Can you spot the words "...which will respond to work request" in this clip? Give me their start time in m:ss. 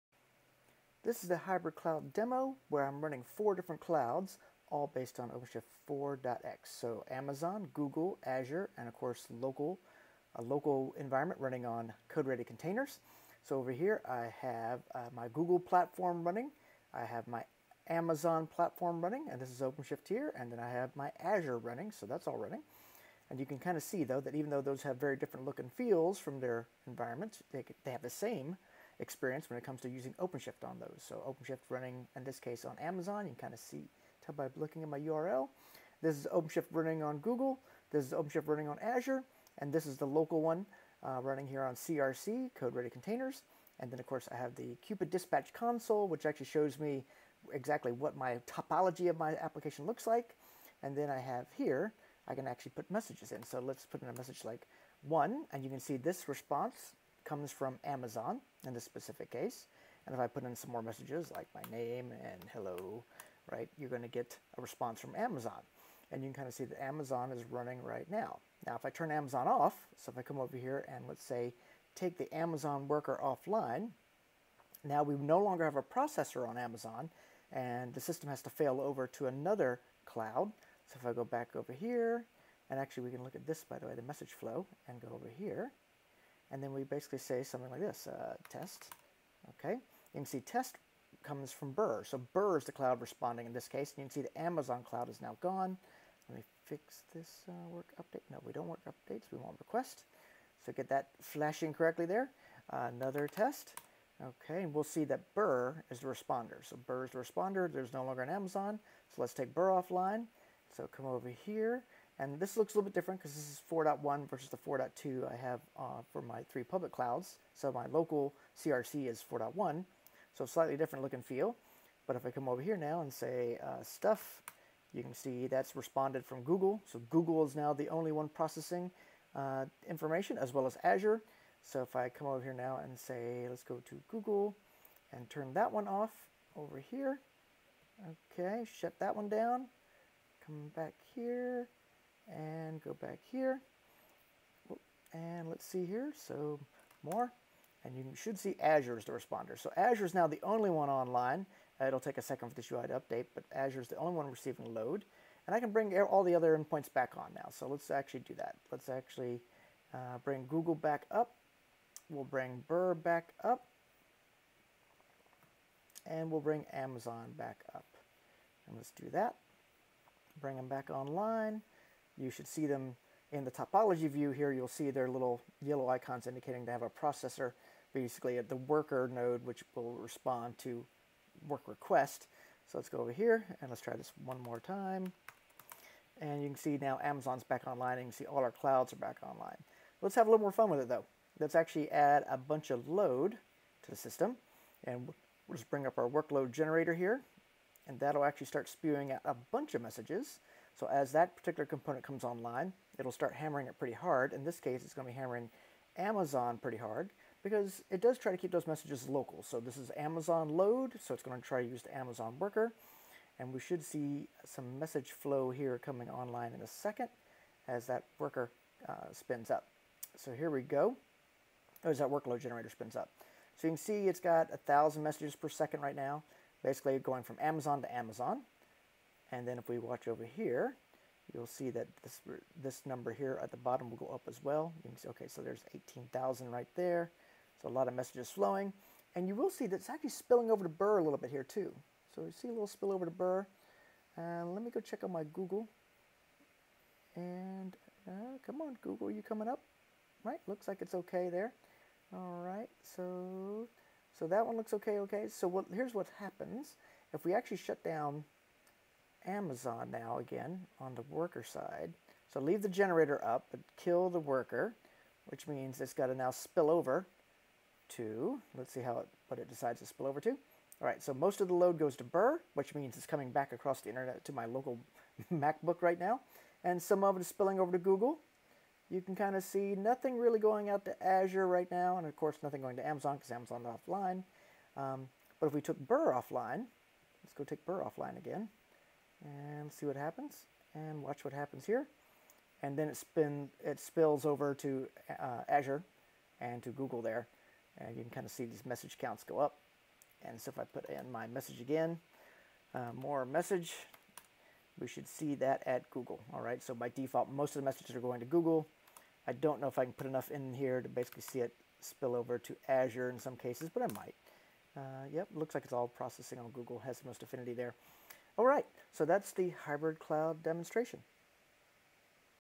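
2:59.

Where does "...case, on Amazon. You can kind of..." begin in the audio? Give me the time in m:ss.
0:32.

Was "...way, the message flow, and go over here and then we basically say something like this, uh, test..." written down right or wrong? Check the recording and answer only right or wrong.
right.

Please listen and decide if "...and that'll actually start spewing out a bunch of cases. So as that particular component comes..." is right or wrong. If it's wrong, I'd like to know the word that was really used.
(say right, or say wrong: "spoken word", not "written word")
wrong: "messages", not "cases".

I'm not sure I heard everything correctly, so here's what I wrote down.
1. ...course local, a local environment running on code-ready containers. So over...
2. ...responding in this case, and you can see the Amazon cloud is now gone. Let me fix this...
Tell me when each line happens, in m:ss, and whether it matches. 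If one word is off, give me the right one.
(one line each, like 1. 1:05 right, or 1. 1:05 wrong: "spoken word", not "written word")
1. 0:08 right
2. 1:32 right.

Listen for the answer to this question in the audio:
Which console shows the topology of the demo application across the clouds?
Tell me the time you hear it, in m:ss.
0:44.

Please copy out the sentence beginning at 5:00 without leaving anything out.
And so if I put in my message again, uh, more message, we should see that at Google.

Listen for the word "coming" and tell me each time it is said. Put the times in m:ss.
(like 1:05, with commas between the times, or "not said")
3:35, 4:09, 4:33.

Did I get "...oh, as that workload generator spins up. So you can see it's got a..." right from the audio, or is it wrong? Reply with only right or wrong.
right.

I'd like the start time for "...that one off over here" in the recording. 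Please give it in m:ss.
2:15.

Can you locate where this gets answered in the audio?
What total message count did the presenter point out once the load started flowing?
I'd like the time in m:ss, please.
3:55.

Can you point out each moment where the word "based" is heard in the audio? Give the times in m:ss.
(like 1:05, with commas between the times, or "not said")
0:04.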